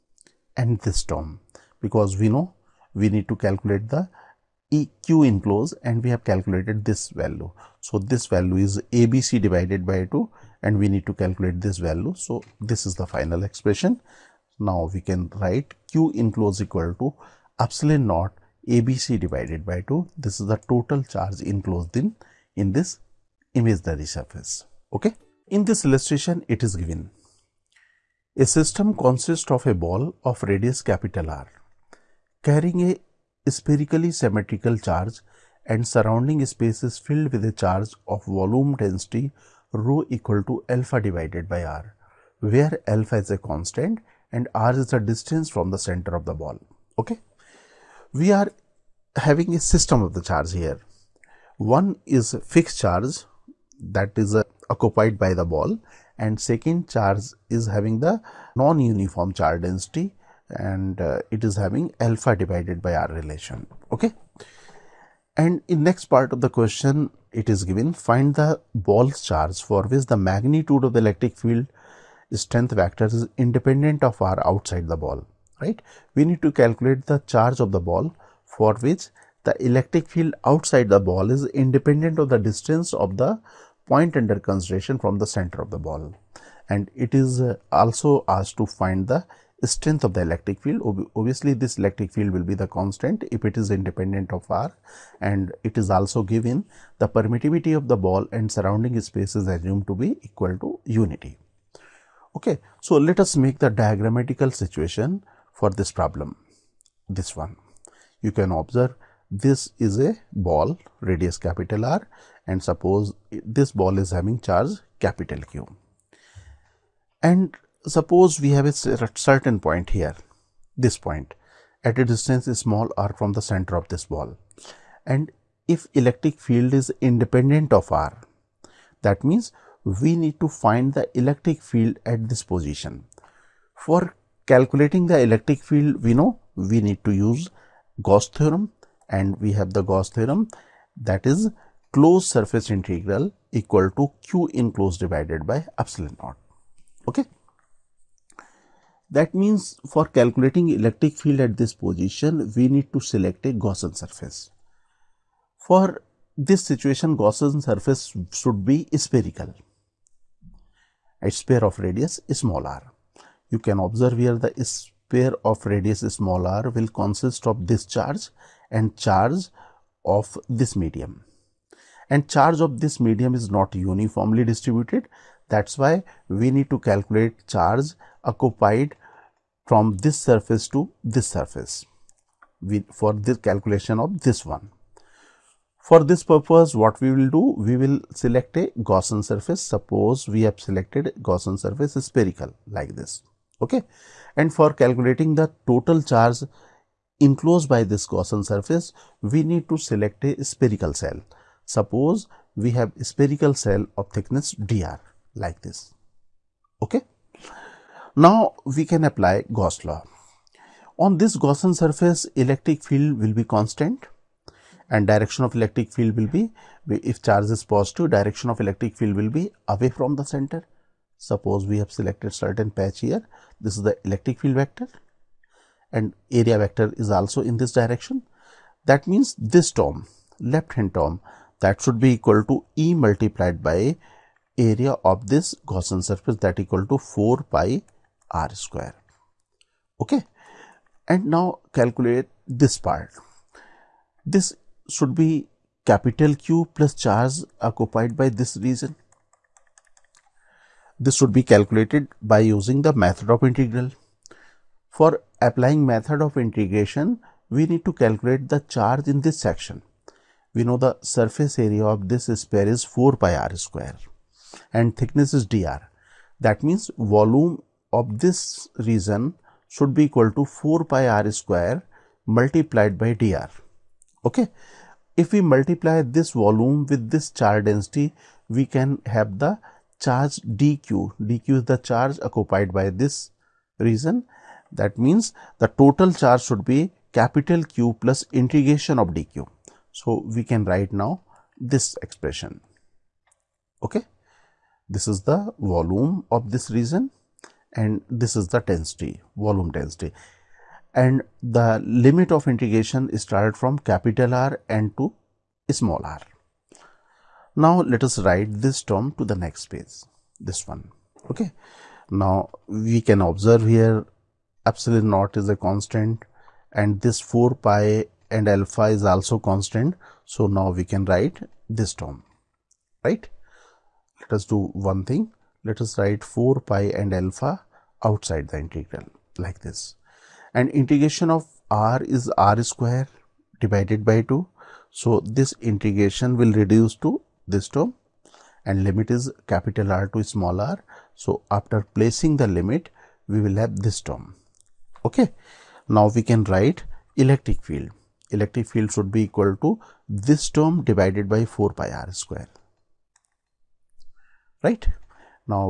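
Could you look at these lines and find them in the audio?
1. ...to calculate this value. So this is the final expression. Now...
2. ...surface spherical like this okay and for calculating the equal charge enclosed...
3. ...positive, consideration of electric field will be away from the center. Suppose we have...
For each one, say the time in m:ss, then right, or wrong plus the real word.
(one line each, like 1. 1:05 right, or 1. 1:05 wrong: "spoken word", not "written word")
1. 0:11 right
2. 3:11 wrong: "total", not "equal"
3. 3:37 wrong: "direction", not "consideration".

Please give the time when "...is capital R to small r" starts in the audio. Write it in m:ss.
5:39.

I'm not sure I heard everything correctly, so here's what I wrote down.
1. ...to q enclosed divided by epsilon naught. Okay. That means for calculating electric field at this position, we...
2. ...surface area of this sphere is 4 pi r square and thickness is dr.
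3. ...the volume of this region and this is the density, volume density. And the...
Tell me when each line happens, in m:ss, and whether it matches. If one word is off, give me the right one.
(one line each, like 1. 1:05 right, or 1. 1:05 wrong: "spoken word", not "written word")
1. 2:23 right
2. 4:21 right
3. 4:55 right.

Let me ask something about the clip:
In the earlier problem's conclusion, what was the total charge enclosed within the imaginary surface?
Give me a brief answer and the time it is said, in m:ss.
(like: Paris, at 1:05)
epsilon naught ABC/2, at 0:17.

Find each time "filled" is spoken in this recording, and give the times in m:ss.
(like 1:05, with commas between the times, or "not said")
0:36.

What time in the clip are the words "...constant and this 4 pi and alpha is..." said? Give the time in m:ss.
5:15.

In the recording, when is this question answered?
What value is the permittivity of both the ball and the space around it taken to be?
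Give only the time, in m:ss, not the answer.
1:40.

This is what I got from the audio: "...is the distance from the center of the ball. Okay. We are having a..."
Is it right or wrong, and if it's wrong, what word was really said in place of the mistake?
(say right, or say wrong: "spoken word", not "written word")
right.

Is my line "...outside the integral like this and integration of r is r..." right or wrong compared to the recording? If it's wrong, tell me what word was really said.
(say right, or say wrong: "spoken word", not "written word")
right.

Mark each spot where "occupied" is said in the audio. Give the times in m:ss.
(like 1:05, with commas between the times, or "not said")
0:54, 2:58, 4:07, 4:42.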